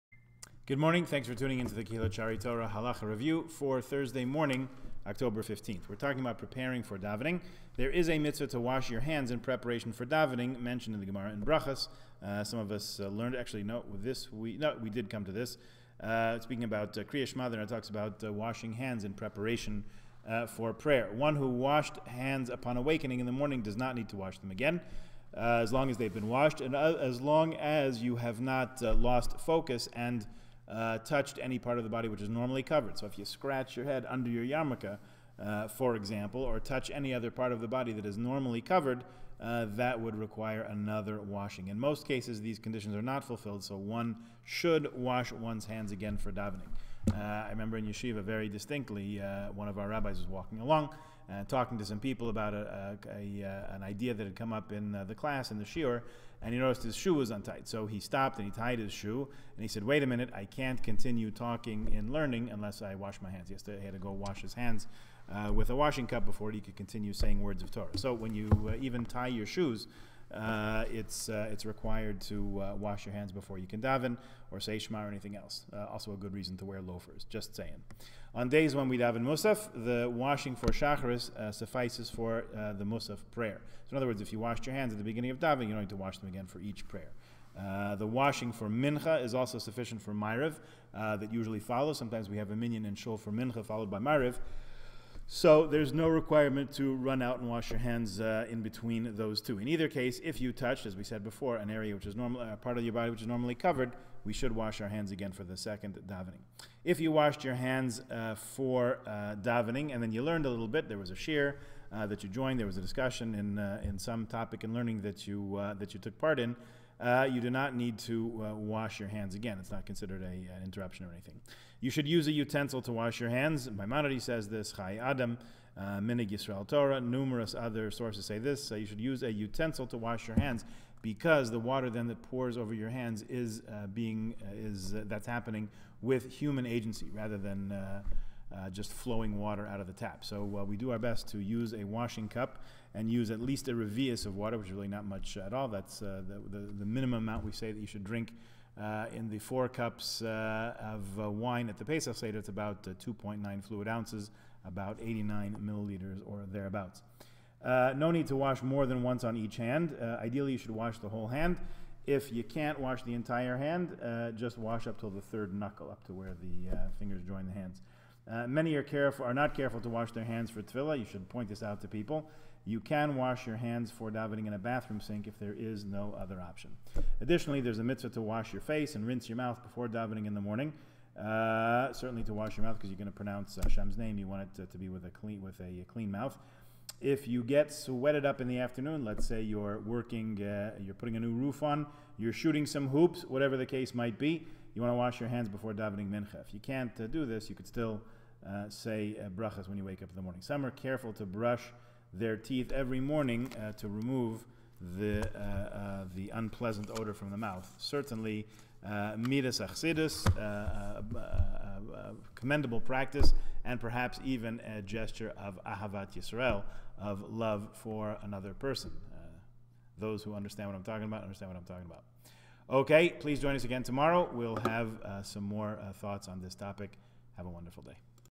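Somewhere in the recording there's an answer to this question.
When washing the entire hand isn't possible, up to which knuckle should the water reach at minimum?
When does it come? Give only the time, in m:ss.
2:45.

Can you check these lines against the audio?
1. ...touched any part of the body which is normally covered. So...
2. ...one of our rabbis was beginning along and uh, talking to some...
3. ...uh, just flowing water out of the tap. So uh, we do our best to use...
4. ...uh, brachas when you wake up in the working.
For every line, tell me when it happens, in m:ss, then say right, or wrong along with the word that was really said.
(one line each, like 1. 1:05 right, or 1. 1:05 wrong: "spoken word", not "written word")
1. 0:30 right
2. 0:49 wrong: "walking", not "beginning"
3. 2:18 right
4. 3:19 wrong: "morning", not "working".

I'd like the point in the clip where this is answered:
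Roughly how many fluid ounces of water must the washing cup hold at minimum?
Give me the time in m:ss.
2:32.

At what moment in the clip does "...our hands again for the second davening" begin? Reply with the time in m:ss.
1:44.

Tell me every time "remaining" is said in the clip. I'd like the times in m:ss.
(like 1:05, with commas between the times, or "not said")
not said.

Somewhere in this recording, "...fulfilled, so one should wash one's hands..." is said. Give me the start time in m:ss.
0:43.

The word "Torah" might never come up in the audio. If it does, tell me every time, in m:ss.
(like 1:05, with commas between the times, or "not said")
0:02, 1:07, 2:06.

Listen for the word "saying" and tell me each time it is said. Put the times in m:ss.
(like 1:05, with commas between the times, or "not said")
1:07, 1:17.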